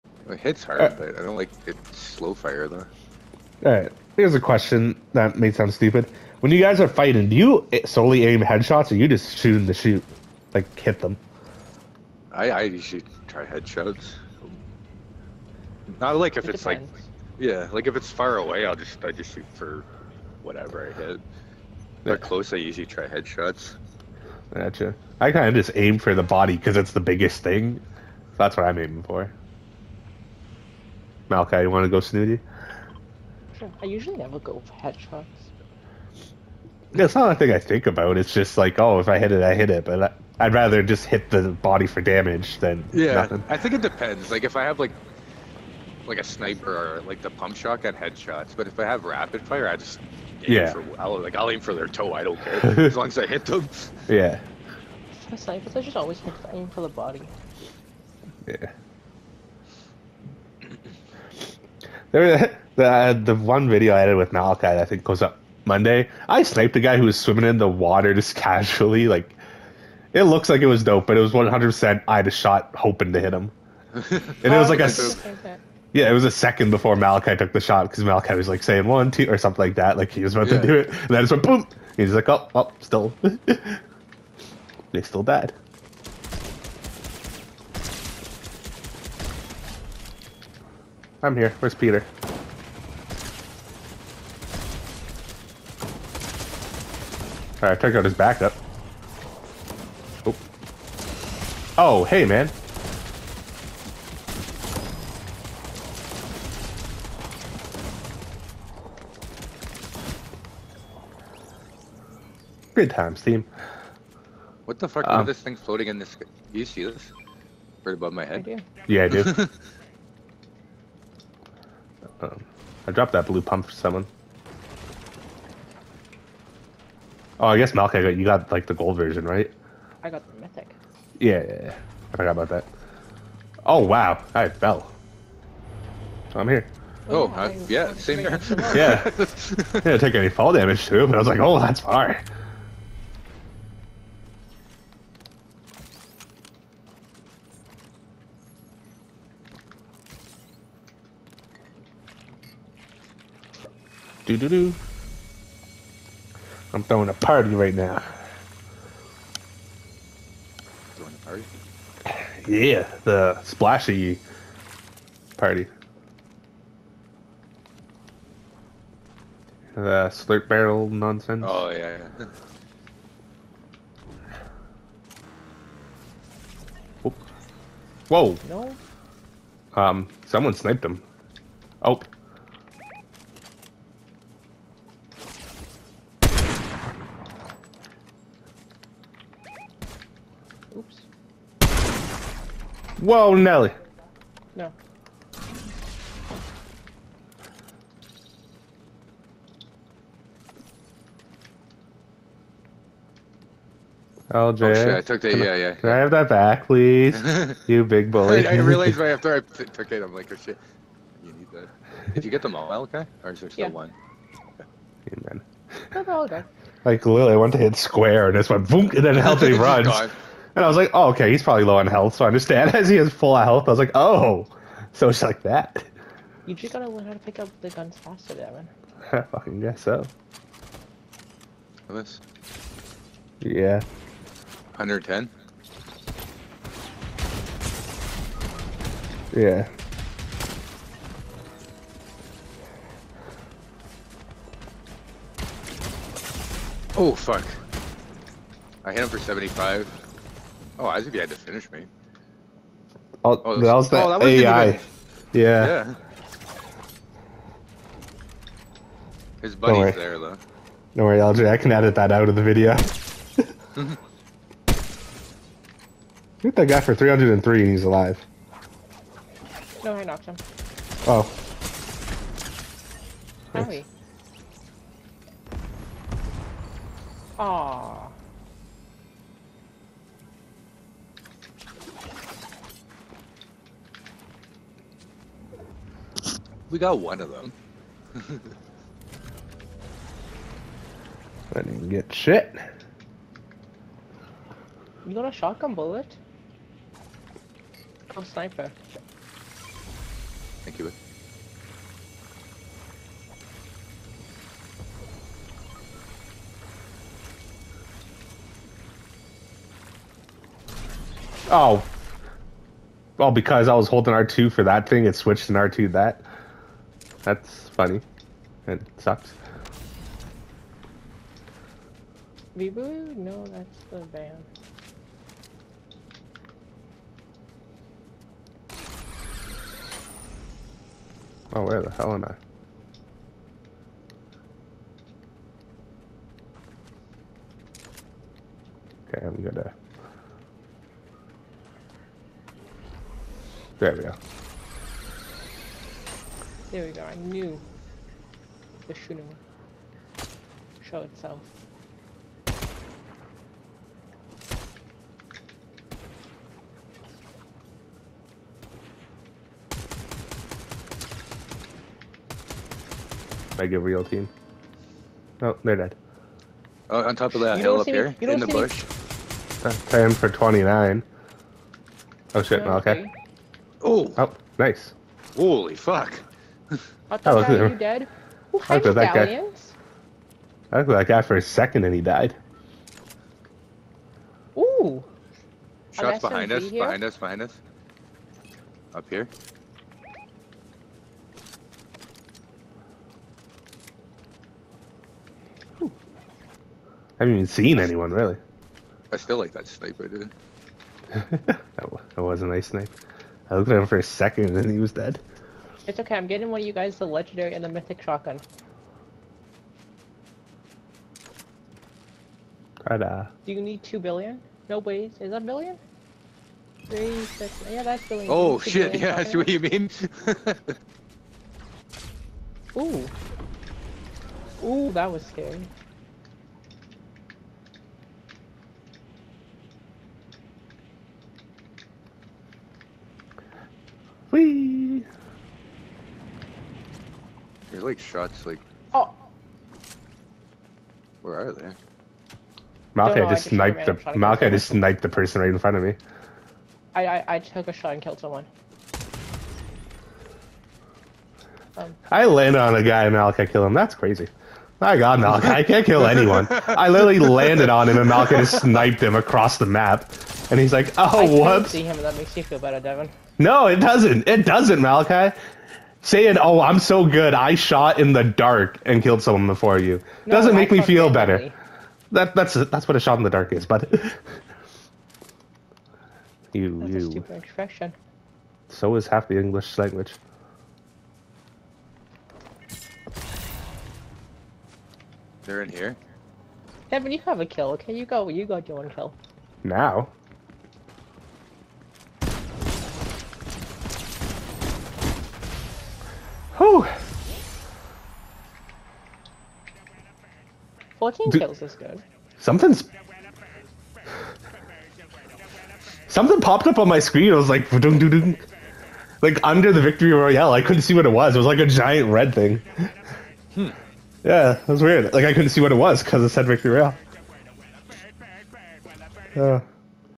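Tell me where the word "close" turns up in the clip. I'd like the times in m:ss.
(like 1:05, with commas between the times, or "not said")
0:22.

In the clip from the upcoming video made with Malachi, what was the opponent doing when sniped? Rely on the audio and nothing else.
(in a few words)
swimming in the water.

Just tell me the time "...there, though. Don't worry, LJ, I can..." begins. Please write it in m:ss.
4:19.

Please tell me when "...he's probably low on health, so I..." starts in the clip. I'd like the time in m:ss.
3:41.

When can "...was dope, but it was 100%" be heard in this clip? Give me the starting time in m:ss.
1:10.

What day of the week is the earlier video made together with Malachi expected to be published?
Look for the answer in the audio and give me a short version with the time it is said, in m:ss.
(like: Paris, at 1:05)
Monday, at 1:05.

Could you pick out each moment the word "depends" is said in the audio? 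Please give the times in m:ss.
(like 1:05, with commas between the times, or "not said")
0:16, 0:43.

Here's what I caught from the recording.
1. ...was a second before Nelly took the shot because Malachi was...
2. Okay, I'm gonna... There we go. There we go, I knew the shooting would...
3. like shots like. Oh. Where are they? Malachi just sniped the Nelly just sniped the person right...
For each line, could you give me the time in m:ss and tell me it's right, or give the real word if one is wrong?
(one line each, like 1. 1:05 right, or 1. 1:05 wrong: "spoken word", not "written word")
1. 1:16 wrong: "Malachi", not "Nelly"
2. 5:39 right
3. 7:17 wrong: "Malachi", not "Nelly".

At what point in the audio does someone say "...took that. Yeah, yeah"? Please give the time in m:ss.
3:25.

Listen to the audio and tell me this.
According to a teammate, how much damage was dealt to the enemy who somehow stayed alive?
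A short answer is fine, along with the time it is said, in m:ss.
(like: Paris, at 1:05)
303, at 4:26.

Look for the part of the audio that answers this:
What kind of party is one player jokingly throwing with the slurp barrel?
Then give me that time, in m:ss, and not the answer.
2:43.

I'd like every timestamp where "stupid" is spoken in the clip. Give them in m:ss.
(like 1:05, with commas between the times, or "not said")
0:05, 7:57.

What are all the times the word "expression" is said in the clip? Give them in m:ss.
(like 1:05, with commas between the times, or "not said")
7:57.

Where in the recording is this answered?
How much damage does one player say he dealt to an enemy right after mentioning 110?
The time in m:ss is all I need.
4:08.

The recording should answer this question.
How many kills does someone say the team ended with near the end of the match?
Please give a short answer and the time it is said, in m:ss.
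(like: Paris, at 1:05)
14, at 8:20.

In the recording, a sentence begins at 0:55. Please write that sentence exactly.
For snipers, I just always aim for the body.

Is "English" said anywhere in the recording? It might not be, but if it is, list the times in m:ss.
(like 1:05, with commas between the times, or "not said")
7:59.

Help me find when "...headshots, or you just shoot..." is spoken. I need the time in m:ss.
0:08.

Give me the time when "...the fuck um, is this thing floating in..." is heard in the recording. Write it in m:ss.
1:54.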